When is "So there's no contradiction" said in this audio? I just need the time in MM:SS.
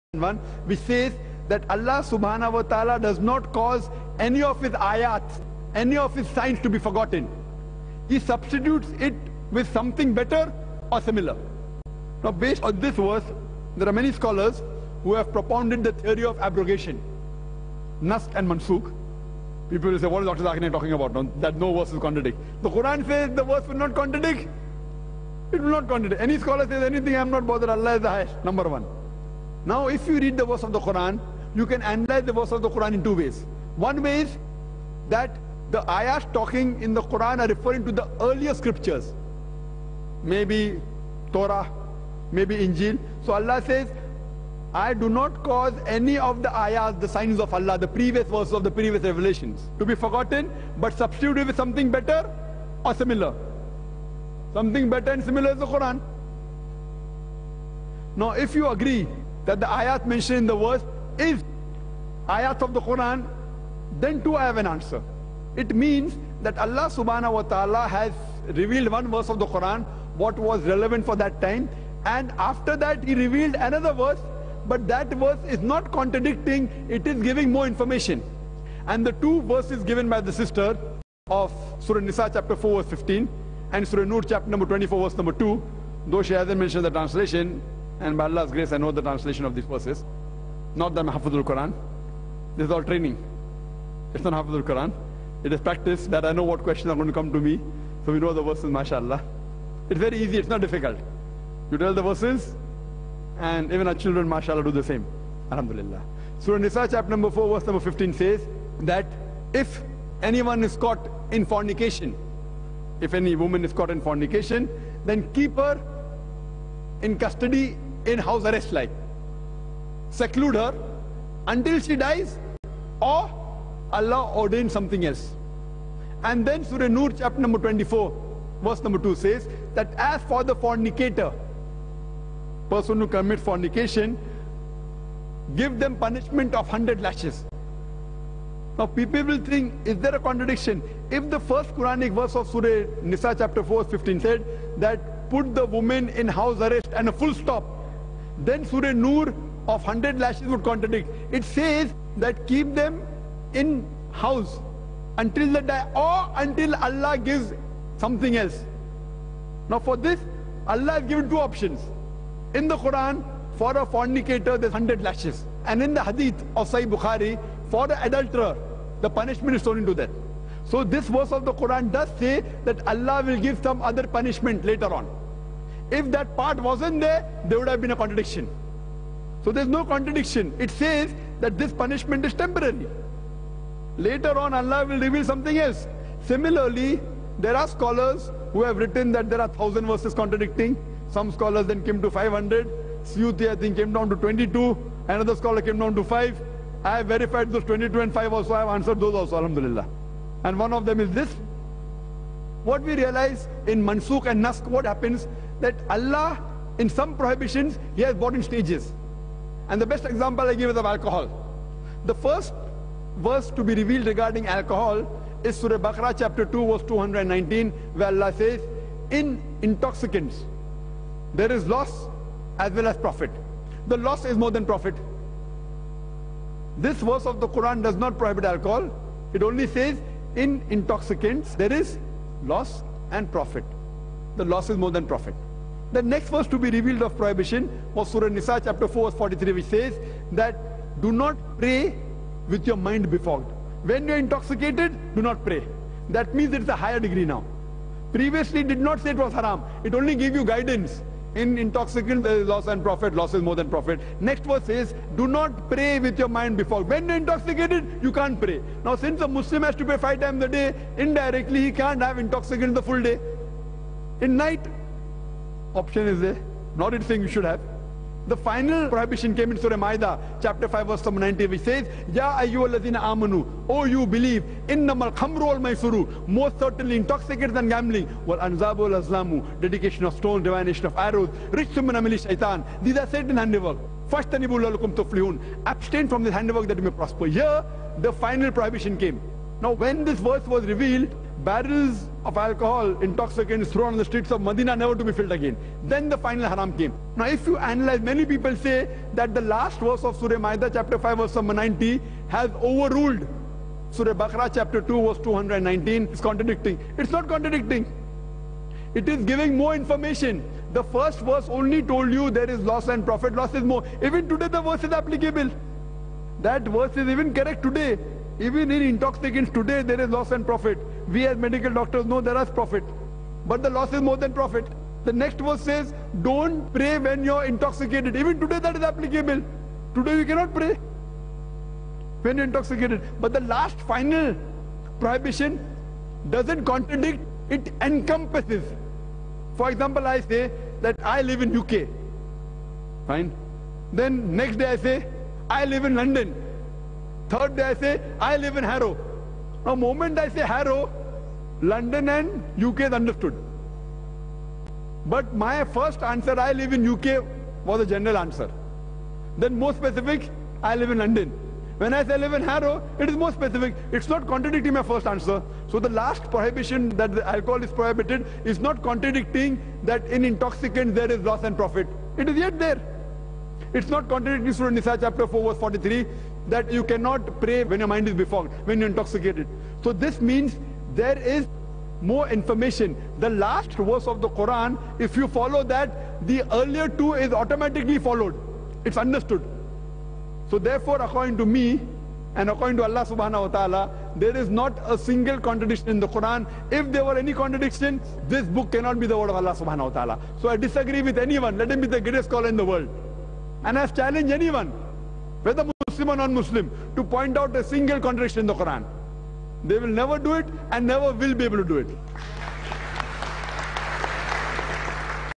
02:59.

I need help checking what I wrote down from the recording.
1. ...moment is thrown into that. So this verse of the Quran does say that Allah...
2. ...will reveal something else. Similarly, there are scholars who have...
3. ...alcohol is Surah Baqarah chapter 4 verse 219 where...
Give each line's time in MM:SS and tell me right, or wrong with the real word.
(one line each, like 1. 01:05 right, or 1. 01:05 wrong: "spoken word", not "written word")
1. 02:49 wrong: "punishment", not "moment"
2. 03:04 right
3. 03:34 wrong: "2", not "4".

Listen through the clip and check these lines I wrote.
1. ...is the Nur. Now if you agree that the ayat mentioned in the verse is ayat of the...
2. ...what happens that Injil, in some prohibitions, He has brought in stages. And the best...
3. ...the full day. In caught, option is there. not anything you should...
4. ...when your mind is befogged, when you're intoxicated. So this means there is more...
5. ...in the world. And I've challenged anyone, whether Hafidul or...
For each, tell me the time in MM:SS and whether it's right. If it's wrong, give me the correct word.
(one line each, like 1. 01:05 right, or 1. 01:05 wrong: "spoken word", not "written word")
1. 00:55 wrong: "Quran", not "Nur"
2. 03:24 wrong: "Allah", not "Injil"
3. 04:22 wrong: "night", not "caught"
4. 06:17 right
5. 06:42 wrong: "Muslim", not "Hafidul".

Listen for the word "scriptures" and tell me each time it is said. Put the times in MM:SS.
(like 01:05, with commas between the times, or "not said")
00:38.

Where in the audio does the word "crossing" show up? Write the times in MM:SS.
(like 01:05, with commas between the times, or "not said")
not said.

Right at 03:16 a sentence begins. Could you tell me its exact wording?
I have verified those 22 and 5 also.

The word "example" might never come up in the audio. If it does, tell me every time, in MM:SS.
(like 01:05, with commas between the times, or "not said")
03:30, 05:39.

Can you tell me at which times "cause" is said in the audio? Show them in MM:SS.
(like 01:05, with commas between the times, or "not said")
00:03, 00:45.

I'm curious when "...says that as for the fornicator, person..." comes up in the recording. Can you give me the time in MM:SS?
02:09.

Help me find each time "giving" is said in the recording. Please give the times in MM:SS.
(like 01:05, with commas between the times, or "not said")
01:17, 05:09.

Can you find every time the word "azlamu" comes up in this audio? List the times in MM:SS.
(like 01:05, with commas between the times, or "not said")
04:39.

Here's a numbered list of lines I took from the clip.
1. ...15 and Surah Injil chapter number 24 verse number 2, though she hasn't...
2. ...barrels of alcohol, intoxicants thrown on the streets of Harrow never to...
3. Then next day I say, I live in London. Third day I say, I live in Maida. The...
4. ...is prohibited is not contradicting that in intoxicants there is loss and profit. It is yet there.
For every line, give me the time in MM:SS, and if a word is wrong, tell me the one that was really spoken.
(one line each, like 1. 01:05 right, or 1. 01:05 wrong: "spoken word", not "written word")
1. 01:22 wrong: "Nur", not "Injil"
2. 04:51 wrong: "Medina", not "Harrow"
3. 05:43 wrong: "Harrow", not "Maida"
4. 06:07 right.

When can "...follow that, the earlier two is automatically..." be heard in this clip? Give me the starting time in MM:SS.
06:25.